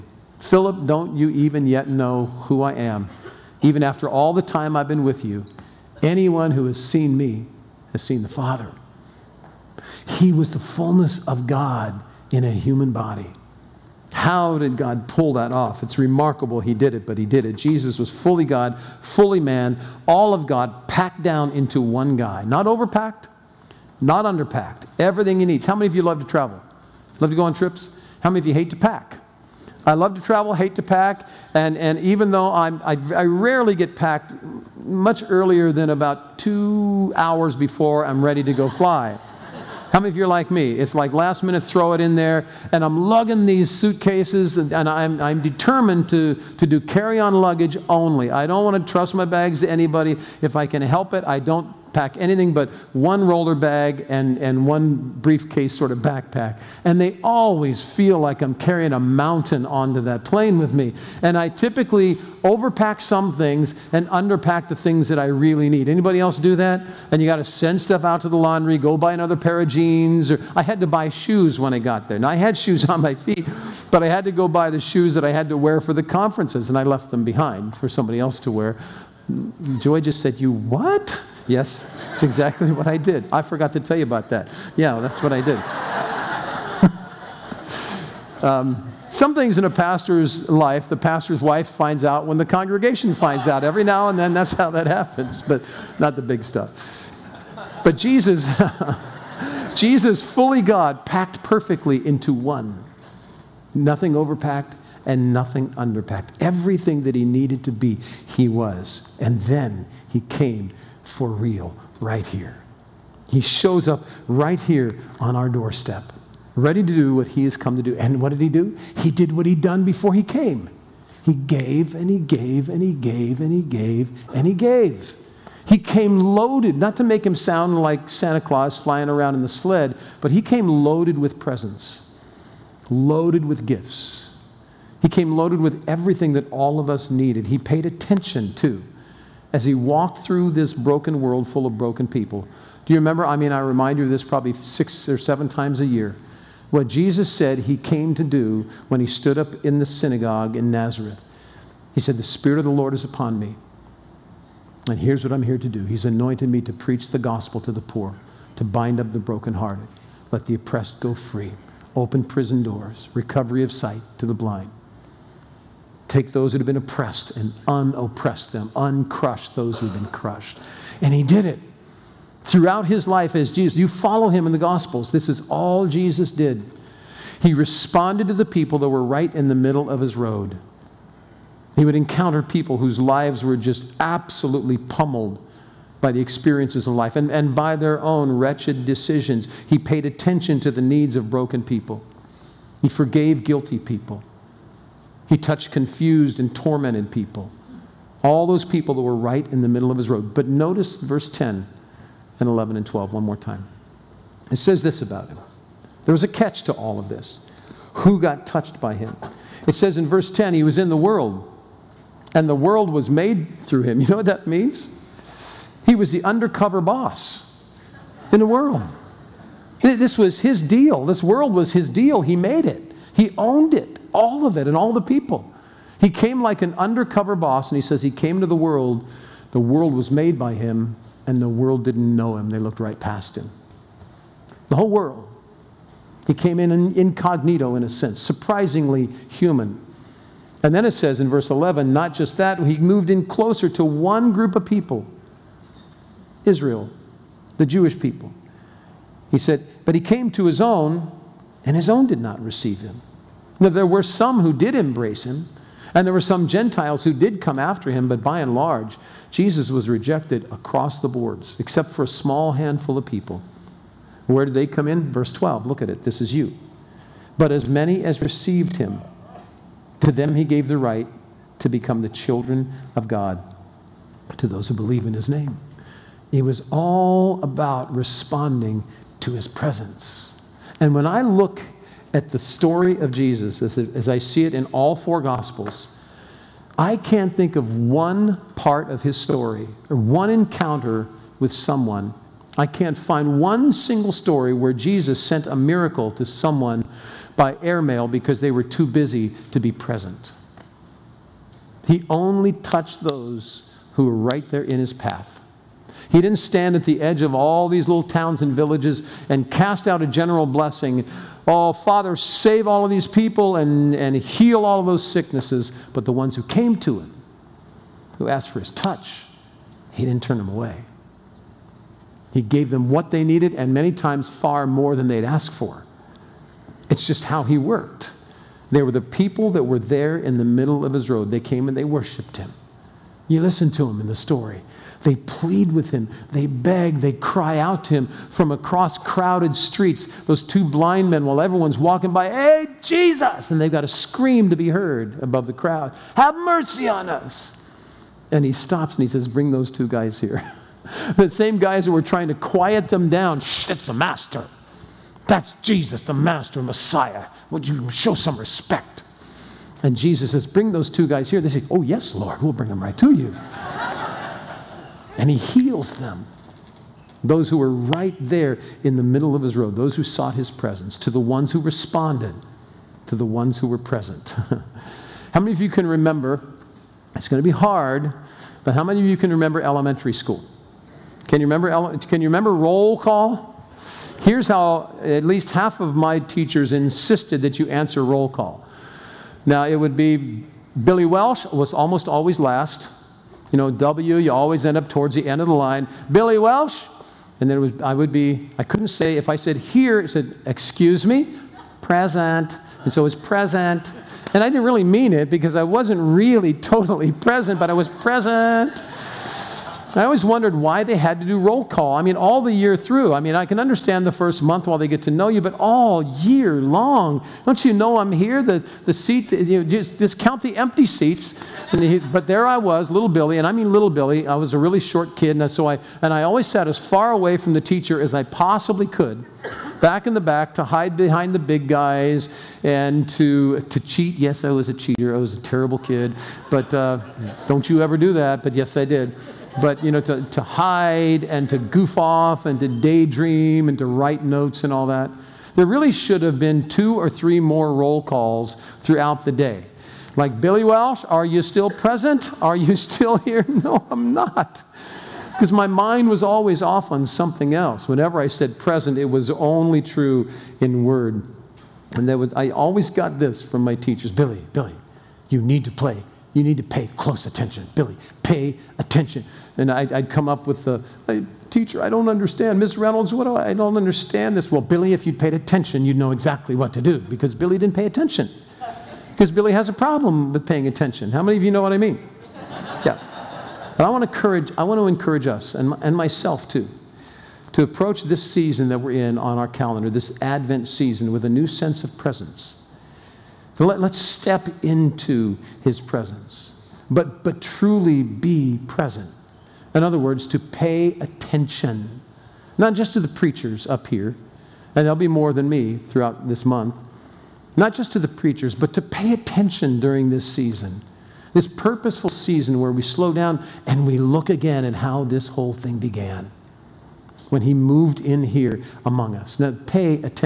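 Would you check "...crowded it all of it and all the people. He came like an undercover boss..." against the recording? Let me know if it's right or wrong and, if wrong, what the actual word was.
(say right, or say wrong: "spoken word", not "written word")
wrong: "owned", not "crowded".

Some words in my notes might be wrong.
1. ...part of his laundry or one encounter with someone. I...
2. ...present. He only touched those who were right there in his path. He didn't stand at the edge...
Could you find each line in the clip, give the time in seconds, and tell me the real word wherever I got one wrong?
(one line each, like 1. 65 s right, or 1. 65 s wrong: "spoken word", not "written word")
1. 288 s wrong: "story", not "laundry"
2. 299 s right.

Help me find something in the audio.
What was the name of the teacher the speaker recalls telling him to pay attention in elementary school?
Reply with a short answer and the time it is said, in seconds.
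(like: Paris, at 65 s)
Miss Reynolds, at 472 s.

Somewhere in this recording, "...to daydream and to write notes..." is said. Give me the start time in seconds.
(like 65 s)
442 s.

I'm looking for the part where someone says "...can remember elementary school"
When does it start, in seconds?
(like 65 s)
379 s.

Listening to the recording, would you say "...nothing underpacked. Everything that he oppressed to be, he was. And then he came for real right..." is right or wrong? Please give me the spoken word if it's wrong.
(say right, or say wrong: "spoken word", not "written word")
wrong: "needed", not "oppressed".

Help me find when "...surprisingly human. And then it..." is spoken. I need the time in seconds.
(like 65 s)
238 s.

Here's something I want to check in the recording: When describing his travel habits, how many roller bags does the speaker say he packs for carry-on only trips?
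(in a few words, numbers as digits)
1.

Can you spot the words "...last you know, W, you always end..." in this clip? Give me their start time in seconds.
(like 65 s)
392 s.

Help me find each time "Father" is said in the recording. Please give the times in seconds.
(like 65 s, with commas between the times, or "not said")
8 s, 311 s.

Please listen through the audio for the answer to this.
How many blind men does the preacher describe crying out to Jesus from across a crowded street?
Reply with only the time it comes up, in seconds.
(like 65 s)
340 s.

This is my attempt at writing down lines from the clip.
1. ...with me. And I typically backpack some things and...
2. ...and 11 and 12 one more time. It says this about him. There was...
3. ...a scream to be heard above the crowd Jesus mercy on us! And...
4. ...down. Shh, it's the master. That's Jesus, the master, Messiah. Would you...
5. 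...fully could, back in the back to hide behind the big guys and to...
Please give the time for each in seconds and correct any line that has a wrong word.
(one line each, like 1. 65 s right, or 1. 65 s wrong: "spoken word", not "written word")
1. 60 s wrong: "overpack", not "backpack"
2. 202 s right
3. 343 s wrong: "Have", not "Jesus"
4. 353 s right
5. 428 s wrong: "possibly", not "fully".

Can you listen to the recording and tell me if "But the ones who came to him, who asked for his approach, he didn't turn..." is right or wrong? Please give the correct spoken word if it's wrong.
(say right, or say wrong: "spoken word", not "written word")
wrong: "touch", not "approach".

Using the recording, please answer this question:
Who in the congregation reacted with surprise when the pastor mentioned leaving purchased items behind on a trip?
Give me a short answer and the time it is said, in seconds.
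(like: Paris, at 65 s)
Joy, at 79 s.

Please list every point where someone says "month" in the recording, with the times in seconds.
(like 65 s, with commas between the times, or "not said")
414 s, 506 s.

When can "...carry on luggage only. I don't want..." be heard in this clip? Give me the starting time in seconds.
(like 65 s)
46 s.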